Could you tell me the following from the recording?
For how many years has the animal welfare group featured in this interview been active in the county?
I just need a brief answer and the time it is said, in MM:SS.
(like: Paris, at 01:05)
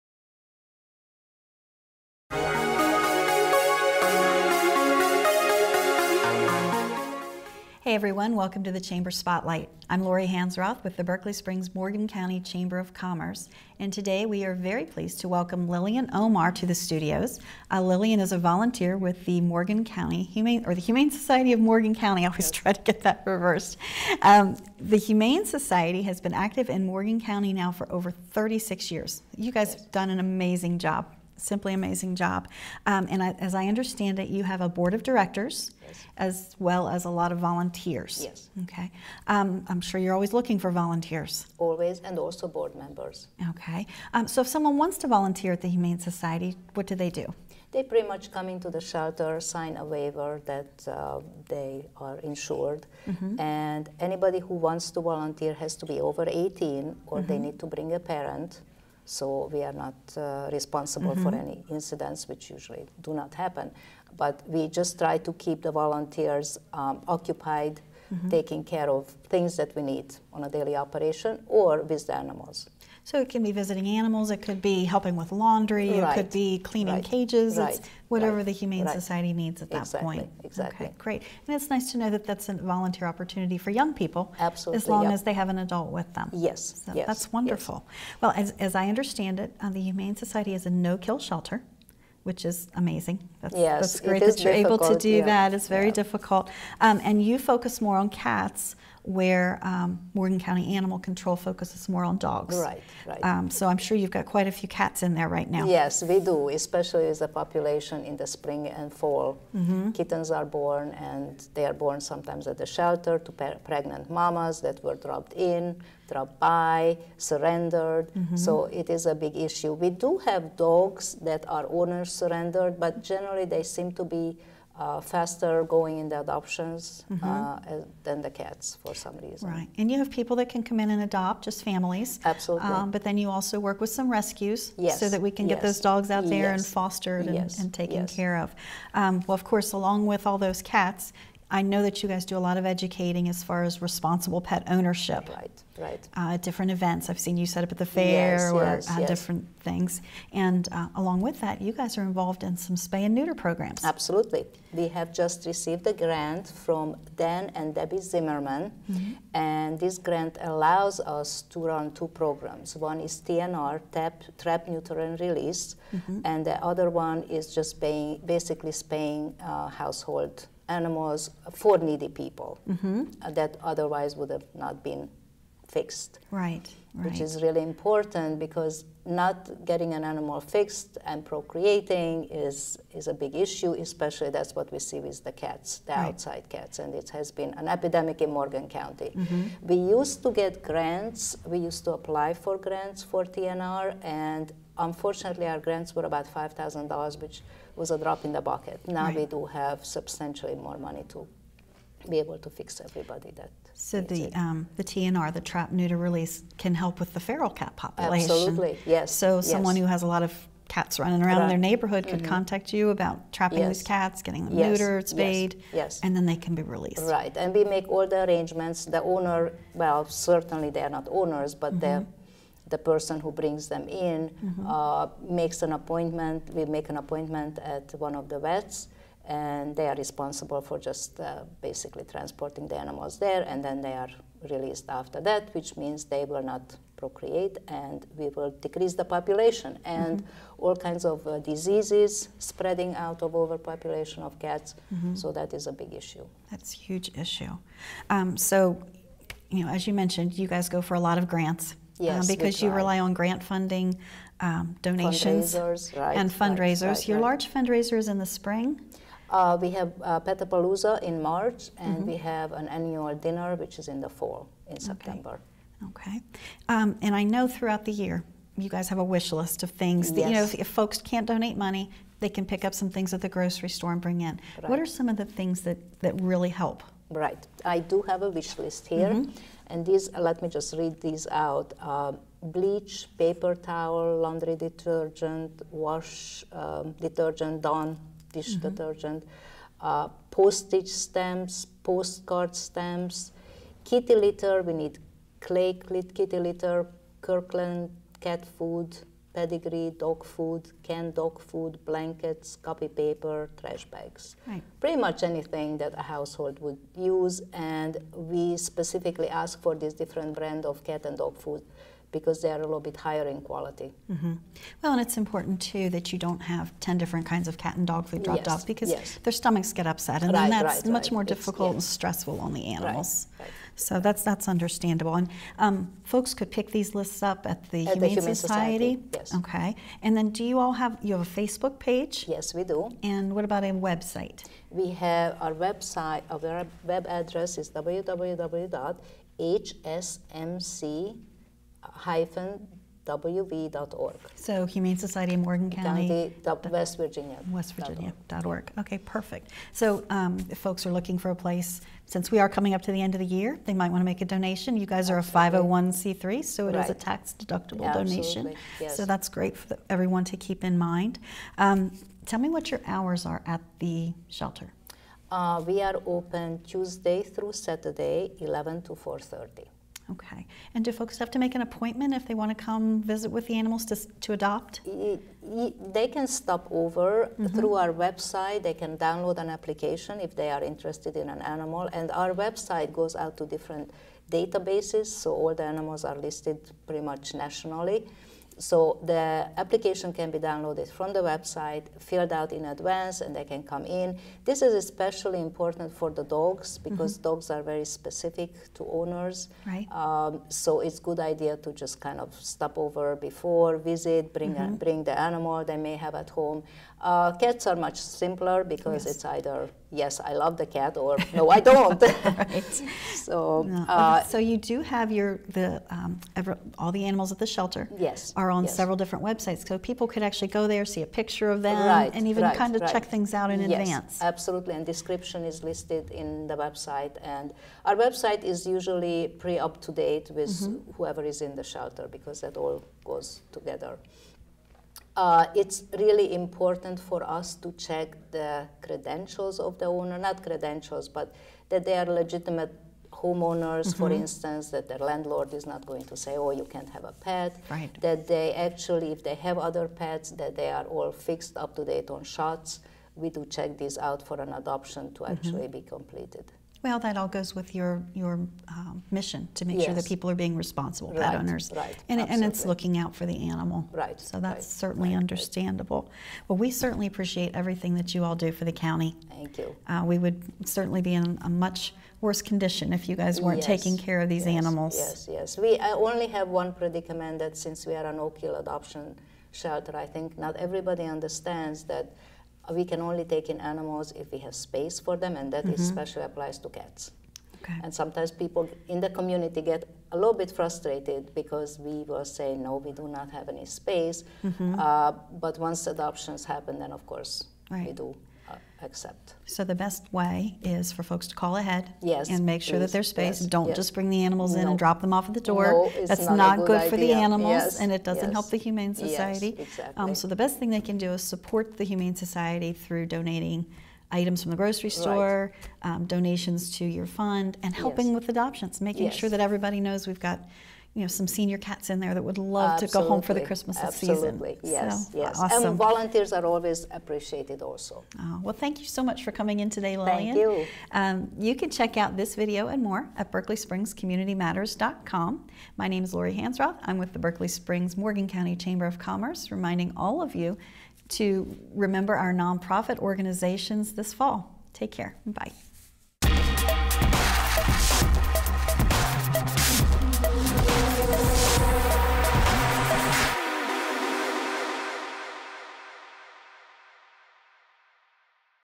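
over 36 years, at 00:27.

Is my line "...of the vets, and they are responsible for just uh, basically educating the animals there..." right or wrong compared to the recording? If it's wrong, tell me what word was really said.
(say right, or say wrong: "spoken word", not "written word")
wrong: "transporting", not "educating".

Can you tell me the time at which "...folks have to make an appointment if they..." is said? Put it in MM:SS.
06:10.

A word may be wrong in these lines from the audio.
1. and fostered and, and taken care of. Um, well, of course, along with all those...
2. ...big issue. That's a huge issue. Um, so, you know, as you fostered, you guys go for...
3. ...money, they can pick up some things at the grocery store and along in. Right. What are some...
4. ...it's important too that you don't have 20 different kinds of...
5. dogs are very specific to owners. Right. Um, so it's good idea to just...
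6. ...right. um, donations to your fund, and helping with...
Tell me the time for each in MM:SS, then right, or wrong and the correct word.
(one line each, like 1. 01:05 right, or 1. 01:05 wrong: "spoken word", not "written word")
1. 02:16 right
2. 04:05 wrong: "mentioned", not "fostered"
3. 04:31 wrong: "bring", not "along"
4. 05:15 wrong: "10", not "20"
5. 06:37 right
6. 08:35 right.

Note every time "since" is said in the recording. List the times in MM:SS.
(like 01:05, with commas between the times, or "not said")
05:52, 07:57.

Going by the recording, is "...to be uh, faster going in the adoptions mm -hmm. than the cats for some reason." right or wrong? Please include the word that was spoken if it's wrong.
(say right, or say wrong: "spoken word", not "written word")
right.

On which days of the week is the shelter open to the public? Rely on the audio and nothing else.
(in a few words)
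Tuesday through Saturday.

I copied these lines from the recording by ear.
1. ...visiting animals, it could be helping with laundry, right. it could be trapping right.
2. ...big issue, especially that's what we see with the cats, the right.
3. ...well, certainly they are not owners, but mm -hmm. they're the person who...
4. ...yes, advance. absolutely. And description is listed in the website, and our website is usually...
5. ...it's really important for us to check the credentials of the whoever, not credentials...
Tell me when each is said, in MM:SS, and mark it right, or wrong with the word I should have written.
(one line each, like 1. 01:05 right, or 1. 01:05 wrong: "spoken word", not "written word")
1. 01:13 wrong: "cleaning", not "trapping"
2. 03:03 right
3. 03:39 right
4. 07:03 right
5. 07:15 wrong: "owner", not "whoever".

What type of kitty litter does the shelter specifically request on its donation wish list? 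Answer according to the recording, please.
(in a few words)
clay.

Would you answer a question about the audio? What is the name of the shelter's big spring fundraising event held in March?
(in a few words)
Petapalooza.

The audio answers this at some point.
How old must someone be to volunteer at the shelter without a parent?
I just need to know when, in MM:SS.
00:56.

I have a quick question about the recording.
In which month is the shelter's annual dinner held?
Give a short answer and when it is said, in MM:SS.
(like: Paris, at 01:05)
September, at 04:24.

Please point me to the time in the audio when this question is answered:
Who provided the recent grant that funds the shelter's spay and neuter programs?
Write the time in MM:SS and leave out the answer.
02:37.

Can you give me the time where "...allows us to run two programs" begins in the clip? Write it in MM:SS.
02:40.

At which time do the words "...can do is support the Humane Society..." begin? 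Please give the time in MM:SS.
08:30.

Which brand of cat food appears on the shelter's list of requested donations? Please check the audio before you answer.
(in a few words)
Kirkland.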